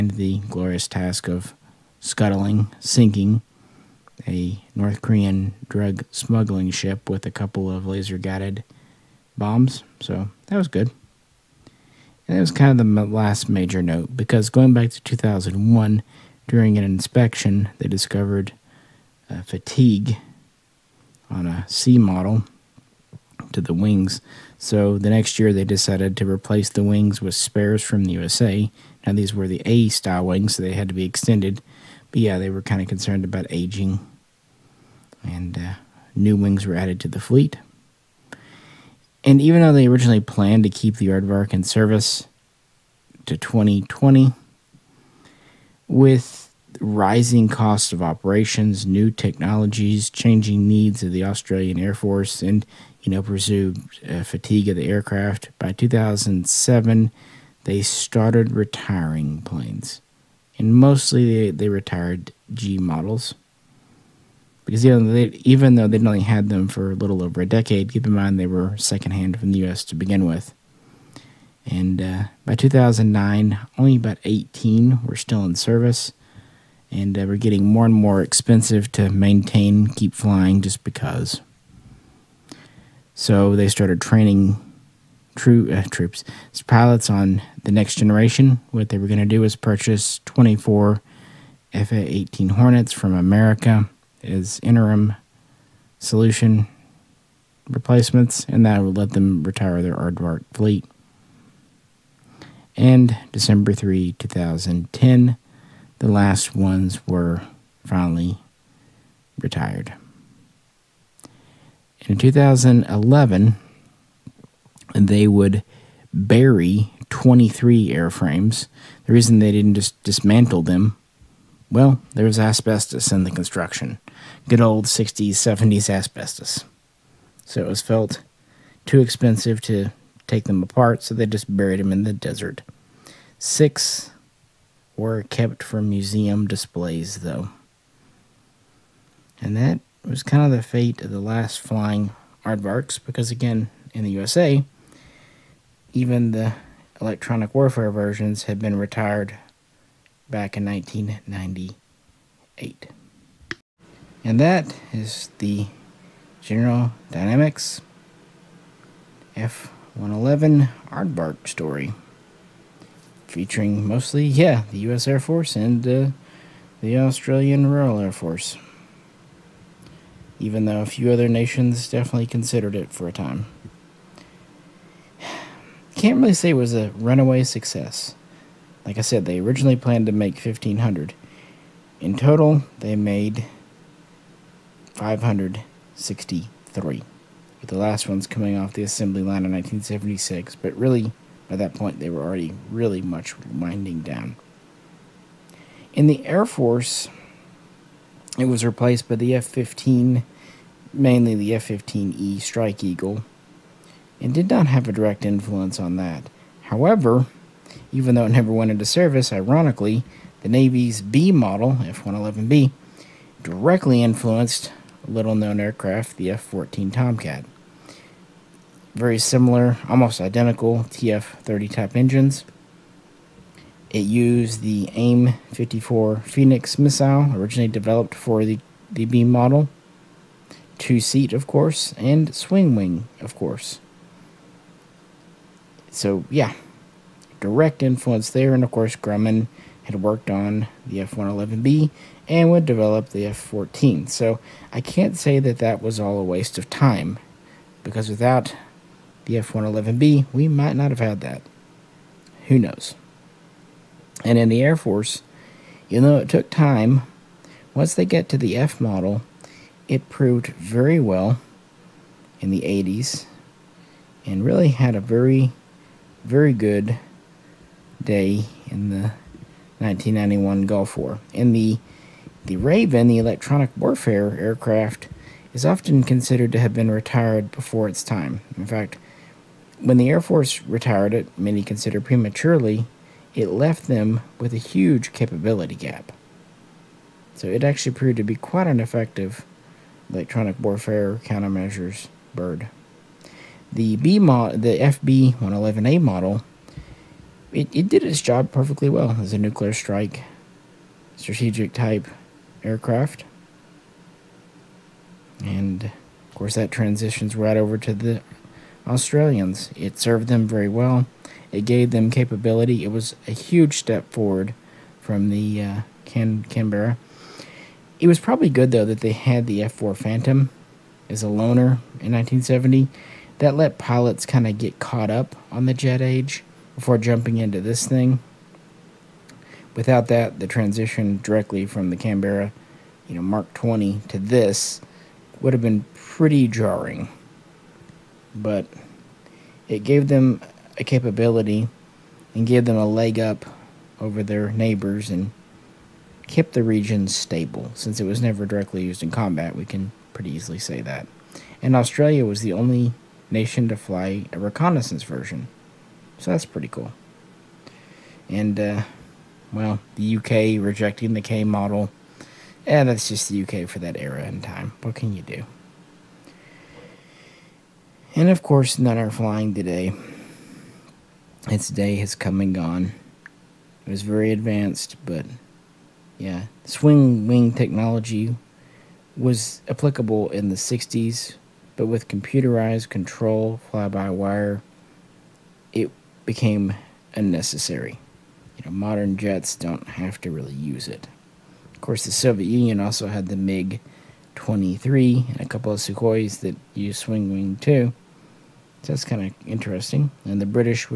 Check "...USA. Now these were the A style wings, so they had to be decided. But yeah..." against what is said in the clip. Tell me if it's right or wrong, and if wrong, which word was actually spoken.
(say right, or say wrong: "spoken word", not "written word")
wrong: "extended", not "decided".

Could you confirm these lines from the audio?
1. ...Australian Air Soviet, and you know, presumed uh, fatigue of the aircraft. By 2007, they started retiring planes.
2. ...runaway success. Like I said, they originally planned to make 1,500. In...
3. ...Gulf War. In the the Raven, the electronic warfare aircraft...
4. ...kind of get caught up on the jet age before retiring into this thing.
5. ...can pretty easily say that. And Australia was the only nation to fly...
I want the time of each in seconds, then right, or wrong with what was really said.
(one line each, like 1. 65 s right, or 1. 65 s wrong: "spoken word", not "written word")
1. 51 s wrong: "Force", not "Soviet"
2. 176 s right
3. 270 s right
4. 324 s wrong: "jumping", not "retiring"
5. 349 s right.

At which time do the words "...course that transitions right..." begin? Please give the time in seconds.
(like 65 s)
306 s.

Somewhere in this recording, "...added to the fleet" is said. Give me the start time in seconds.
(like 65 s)
36 s.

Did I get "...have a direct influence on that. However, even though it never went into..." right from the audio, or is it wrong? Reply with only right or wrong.
right.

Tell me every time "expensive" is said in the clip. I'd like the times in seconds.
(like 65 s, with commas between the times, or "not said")
78 s, 129 s.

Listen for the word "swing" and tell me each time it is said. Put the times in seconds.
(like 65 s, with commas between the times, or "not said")
232 s, 376 s, 396 s.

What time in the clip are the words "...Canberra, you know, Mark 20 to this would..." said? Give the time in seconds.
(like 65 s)
331 s.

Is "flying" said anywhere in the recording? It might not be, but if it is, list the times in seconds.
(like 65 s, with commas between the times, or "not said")
80 s, 141 s, 369 s.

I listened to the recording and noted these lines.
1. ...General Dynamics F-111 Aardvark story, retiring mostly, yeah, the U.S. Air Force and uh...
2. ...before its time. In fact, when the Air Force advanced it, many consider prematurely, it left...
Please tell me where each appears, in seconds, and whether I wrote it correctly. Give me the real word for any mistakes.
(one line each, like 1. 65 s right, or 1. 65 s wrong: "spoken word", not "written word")
1. 156 s wrong: "featuring", not "retiring"
2. 277 s wrong: "retired", not "advanced".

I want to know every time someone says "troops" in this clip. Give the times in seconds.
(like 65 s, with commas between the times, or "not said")
85 s.